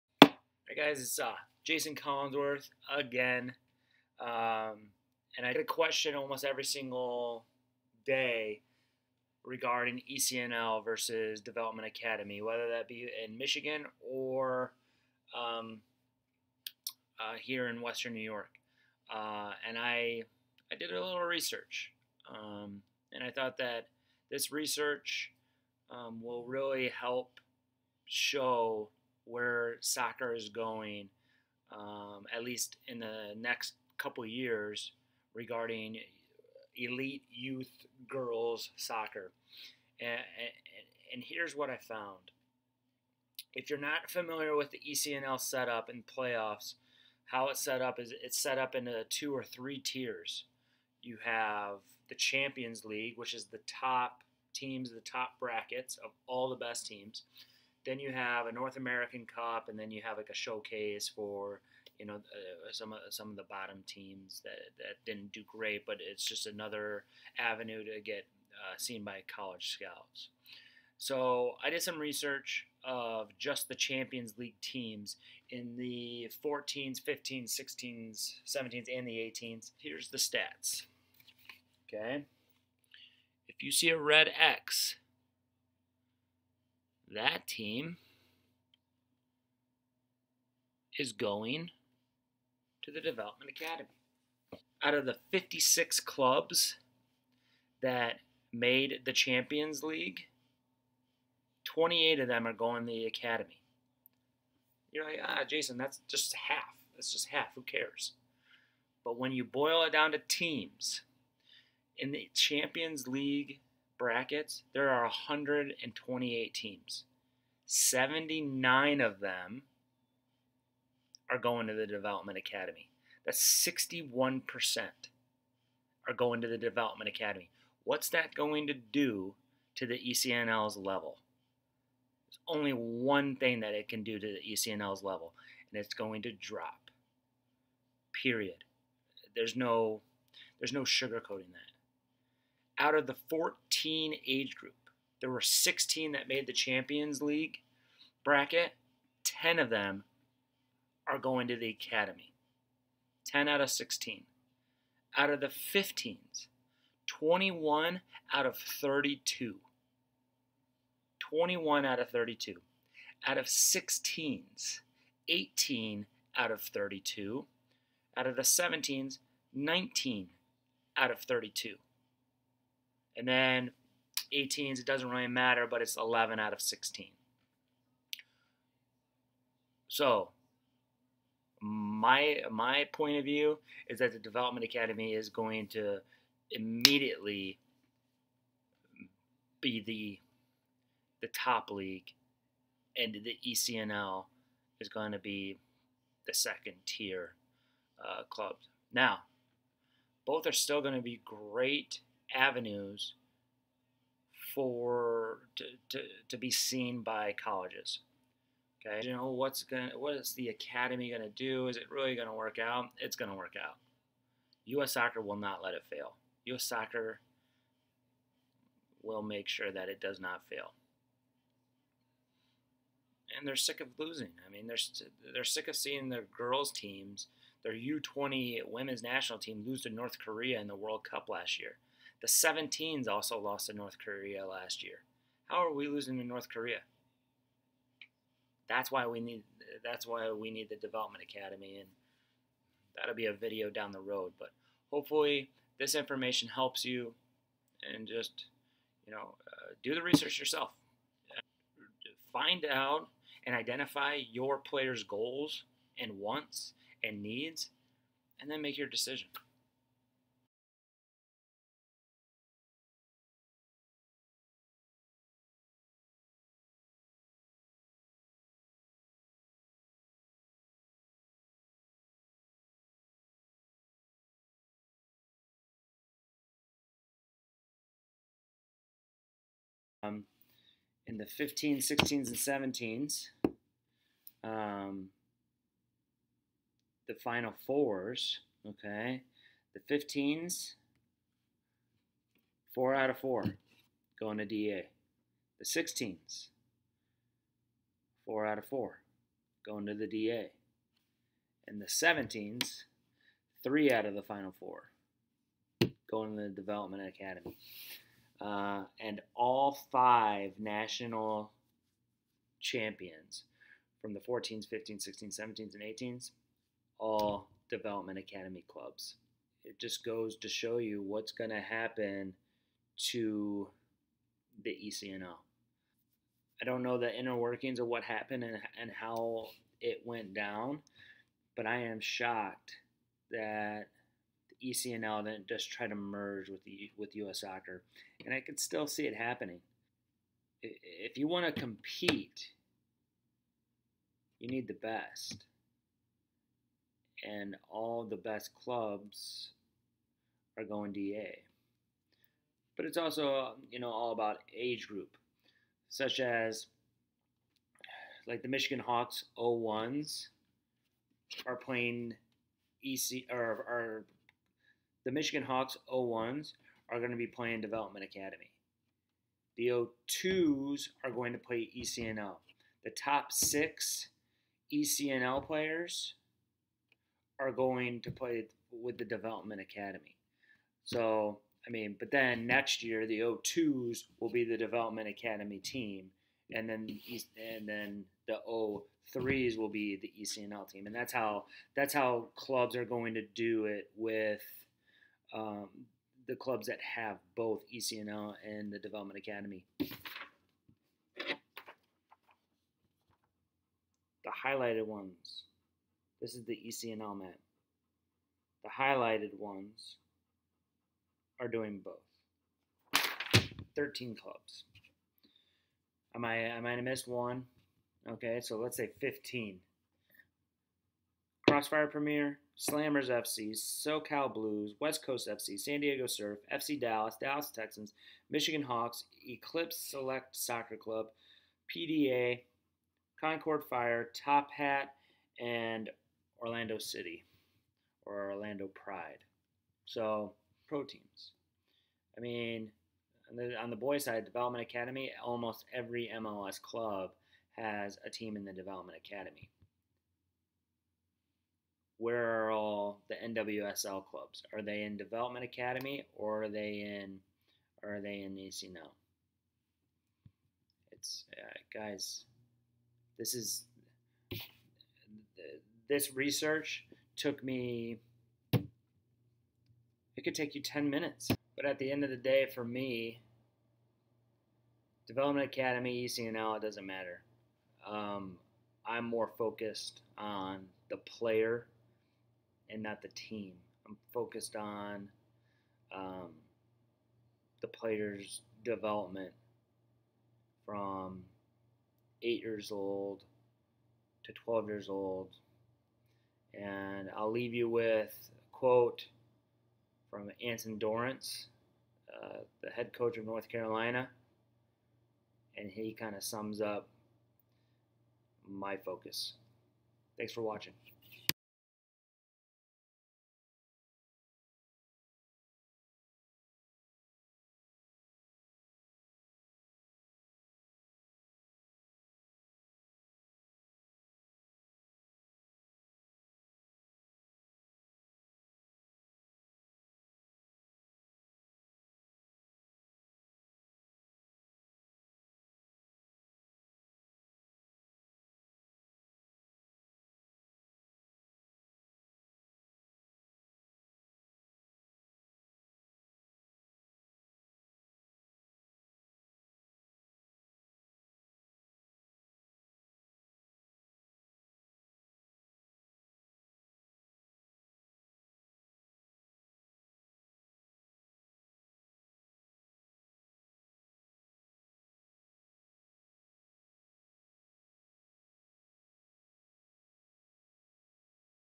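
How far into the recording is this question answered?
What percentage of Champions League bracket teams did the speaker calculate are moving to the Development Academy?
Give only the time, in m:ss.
2:03.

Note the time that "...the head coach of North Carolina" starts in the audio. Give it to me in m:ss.
8:22.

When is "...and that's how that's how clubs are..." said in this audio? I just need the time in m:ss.
6:30.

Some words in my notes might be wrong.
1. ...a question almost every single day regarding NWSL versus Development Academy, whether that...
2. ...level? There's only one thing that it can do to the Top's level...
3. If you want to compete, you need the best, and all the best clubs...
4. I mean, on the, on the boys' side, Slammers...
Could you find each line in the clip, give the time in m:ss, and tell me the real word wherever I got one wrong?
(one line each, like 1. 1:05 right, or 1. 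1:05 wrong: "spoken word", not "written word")
1. 0:05 wrong: "ECNL", not "NWSL"
2. 2:10 wrong: "ECNL", not "Top"
3. 5:40 right
4. 7:22 wrong: "Development", not "Slammers".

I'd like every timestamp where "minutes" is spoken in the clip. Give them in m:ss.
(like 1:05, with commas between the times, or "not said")
7:50.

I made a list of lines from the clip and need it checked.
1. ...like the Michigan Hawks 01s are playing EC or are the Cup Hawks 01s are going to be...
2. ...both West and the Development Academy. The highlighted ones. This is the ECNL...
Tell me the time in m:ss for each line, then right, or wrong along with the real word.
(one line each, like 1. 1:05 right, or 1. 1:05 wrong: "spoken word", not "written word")
1. 5:58 wrong: "Michigan", not "Cup"
2. 6:37 wrong: "ECNL", not "West".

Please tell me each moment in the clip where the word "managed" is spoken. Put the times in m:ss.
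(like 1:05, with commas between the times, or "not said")
not said.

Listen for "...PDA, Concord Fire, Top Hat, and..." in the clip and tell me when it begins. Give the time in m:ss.
7:11.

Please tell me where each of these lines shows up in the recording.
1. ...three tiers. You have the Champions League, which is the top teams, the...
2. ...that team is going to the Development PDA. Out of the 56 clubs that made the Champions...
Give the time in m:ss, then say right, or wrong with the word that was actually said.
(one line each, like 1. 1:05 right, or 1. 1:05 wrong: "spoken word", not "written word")
1. 0:49 right
2. 1:27 wrong: "Academy", not "PDA".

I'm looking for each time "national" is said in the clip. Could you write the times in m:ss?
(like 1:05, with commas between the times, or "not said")
3:49, 5:10.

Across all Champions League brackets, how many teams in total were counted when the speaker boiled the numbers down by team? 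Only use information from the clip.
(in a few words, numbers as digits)
128.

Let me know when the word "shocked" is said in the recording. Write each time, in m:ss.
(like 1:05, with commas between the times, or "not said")
5:31.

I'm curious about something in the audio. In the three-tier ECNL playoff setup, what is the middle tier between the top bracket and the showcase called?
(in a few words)
North American Cup.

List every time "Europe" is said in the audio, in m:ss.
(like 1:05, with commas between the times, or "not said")
not said.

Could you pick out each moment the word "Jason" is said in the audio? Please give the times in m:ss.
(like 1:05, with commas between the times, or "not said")
0:01, 1:45.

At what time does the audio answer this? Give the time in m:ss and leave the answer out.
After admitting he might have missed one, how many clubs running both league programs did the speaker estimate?
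6:58.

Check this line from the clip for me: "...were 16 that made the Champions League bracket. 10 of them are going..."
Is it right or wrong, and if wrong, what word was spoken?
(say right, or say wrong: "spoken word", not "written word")
right.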